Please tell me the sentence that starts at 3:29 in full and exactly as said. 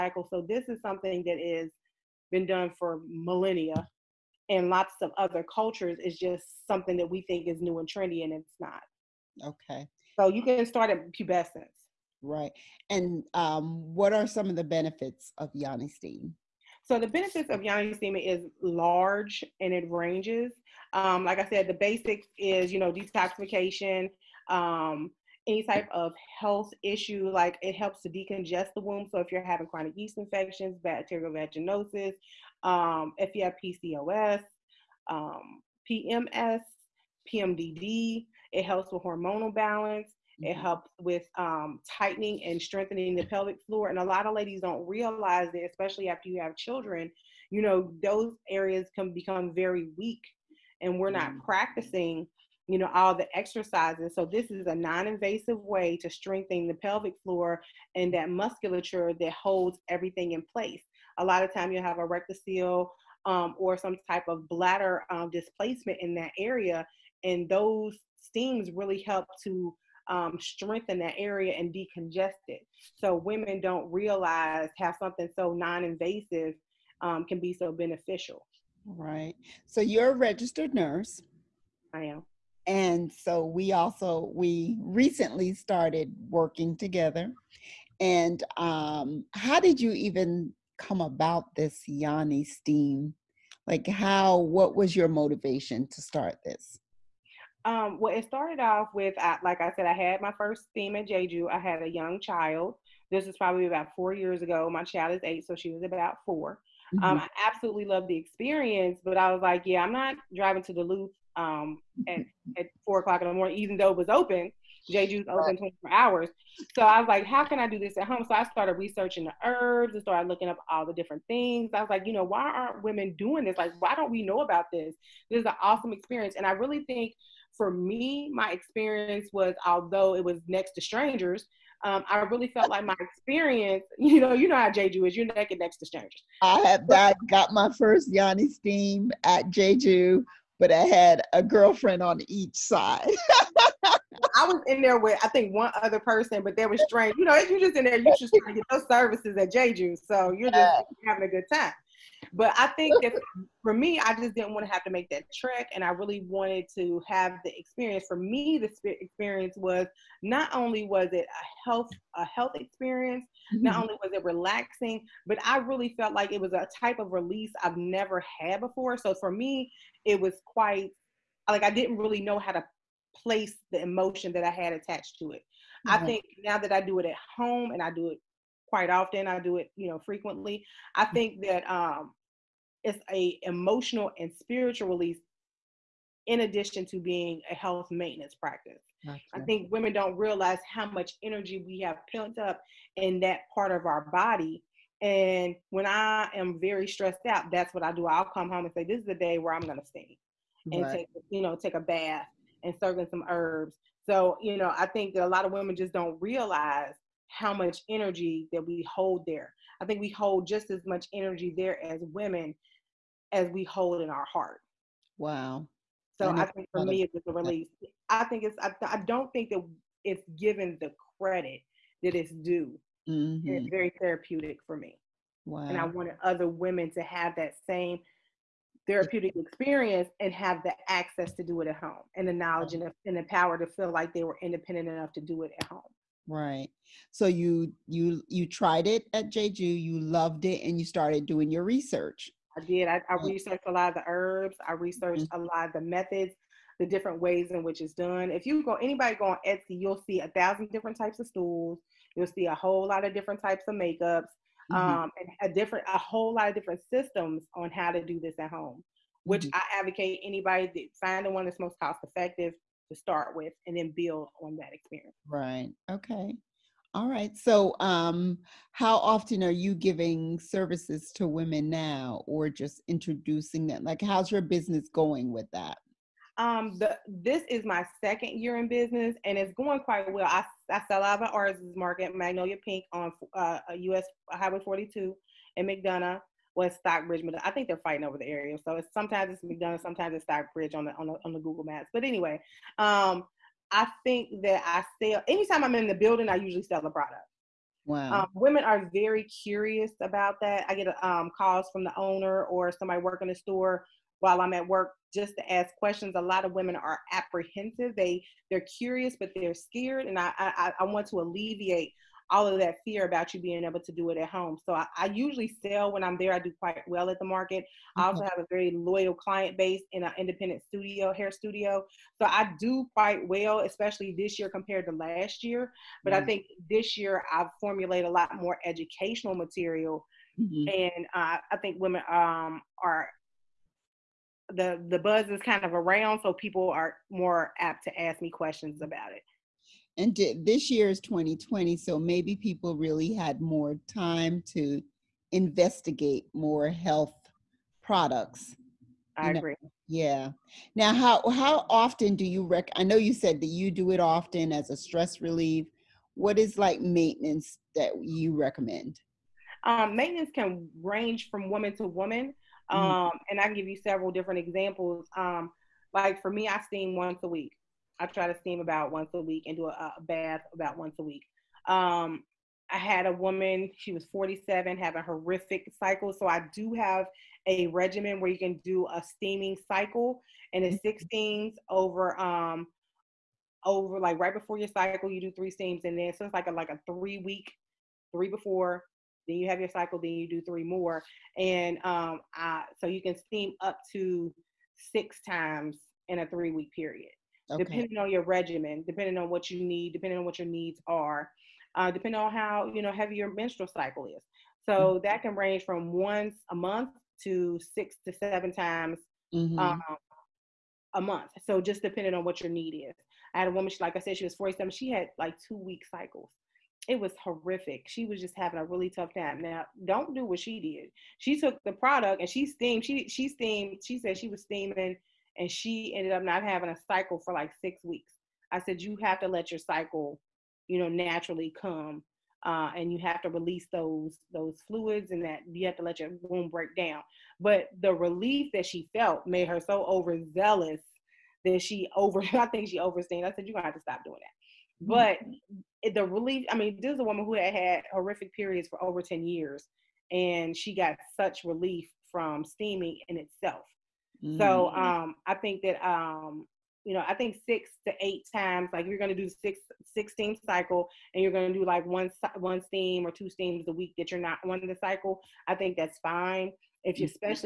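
I think we hold just as much energy there as women as we hold in our heart.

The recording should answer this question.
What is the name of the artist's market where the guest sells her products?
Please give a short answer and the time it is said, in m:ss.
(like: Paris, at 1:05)
Magnolia Pink, at 4:42.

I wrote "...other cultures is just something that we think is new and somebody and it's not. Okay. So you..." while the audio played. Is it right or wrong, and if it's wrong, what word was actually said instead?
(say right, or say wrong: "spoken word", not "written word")
wrong: "trendy", not "somebody".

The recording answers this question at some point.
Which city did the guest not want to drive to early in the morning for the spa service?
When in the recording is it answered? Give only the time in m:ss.
1:50.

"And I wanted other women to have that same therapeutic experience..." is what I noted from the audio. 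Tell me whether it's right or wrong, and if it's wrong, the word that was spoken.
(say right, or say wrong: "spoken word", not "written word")
right.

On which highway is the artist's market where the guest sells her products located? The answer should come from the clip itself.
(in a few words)
US Highway 42.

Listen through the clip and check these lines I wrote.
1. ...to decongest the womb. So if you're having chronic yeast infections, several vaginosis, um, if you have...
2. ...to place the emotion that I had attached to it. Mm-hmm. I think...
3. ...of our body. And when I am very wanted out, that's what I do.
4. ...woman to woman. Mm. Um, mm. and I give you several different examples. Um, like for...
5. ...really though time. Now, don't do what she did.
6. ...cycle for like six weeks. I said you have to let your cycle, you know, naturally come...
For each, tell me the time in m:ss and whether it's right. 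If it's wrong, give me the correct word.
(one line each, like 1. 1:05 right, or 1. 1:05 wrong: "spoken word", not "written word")
1. 0:28 wrong: "bacterial", not "several"
2. 2:52 right
3. 3:13 wrong: "stressed", not "wanted"
4. 6:01 right
5. 6:58 wrong: "tough", not "though"
6. 7:06 right.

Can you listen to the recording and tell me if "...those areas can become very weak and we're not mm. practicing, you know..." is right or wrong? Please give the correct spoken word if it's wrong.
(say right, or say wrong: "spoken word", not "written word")
right.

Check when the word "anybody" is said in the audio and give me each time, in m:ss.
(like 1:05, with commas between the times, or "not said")
4:08, 4:20.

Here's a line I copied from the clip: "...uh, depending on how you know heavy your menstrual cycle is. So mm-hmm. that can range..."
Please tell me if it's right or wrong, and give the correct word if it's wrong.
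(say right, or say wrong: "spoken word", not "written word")
right.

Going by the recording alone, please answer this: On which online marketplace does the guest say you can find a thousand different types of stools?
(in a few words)
Etsy.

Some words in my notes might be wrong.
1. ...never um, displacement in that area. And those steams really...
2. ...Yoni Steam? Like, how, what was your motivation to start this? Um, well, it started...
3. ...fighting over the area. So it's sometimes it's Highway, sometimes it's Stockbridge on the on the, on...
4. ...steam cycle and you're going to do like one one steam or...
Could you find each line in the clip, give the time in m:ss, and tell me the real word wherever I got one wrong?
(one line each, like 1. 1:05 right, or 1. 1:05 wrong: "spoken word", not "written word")
1. 1:04 wrong: "bladder", not "never"
2. 1:31 right
3. 4:47 wrong: "McDonough", not "Highway"
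4. 7:40 right.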